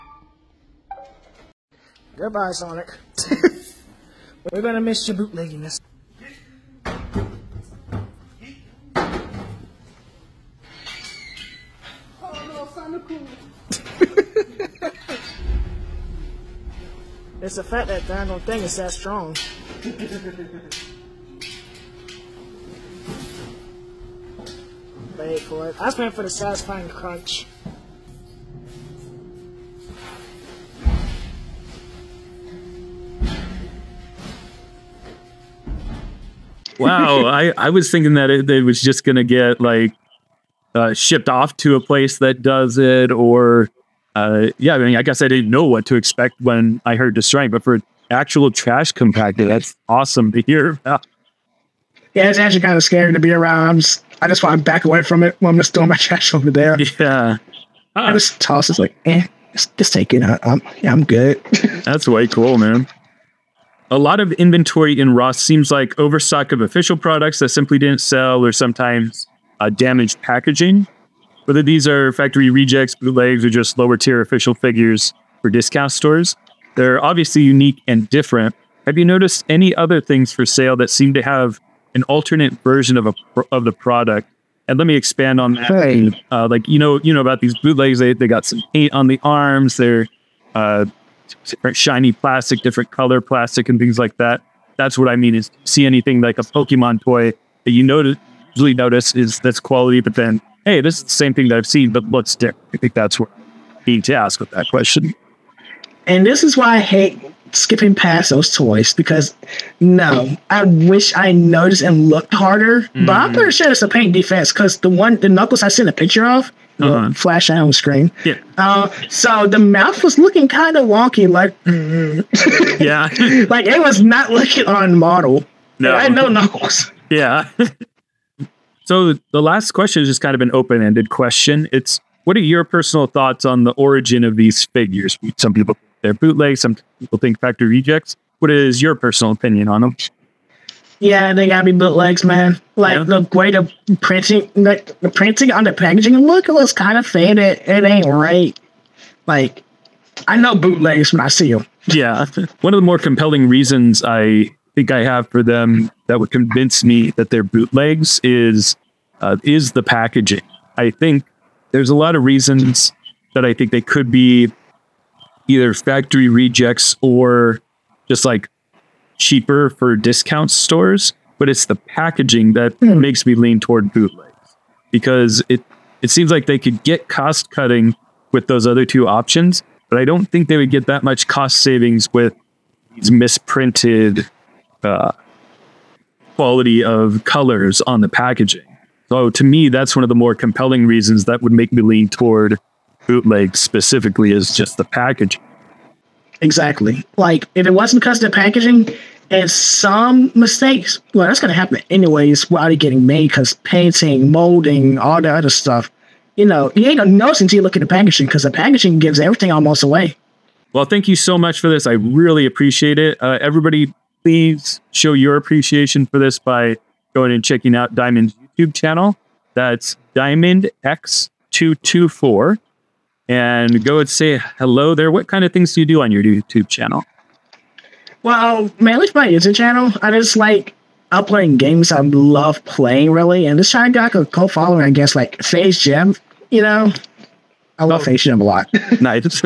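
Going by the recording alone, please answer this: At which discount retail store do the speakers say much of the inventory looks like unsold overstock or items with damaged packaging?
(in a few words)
Ross.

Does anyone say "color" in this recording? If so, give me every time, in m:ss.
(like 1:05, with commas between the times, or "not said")
1:32, 3:07.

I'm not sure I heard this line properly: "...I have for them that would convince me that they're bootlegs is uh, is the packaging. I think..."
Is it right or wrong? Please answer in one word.
right.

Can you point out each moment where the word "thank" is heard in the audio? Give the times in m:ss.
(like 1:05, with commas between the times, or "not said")
3:30.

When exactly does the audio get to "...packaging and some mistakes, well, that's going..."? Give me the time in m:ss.
3:18.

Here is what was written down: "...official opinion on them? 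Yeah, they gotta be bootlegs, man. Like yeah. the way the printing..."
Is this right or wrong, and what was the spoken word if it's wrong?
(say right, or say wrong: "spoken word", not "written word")
wrong: "personal", not "official".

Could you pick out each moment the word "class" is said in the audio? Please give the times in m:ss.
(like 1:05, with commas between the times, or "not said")
not said.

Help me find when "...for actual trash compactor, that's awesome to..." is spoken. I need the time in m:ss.
0:47.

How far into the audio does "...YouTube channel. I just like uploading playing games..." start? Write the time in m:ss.
3:49.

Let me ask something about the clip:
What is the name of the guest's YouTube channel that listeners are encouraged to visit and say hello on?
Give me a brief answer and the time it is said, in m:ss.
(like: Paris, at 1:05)
Diamond X224, at 3:40.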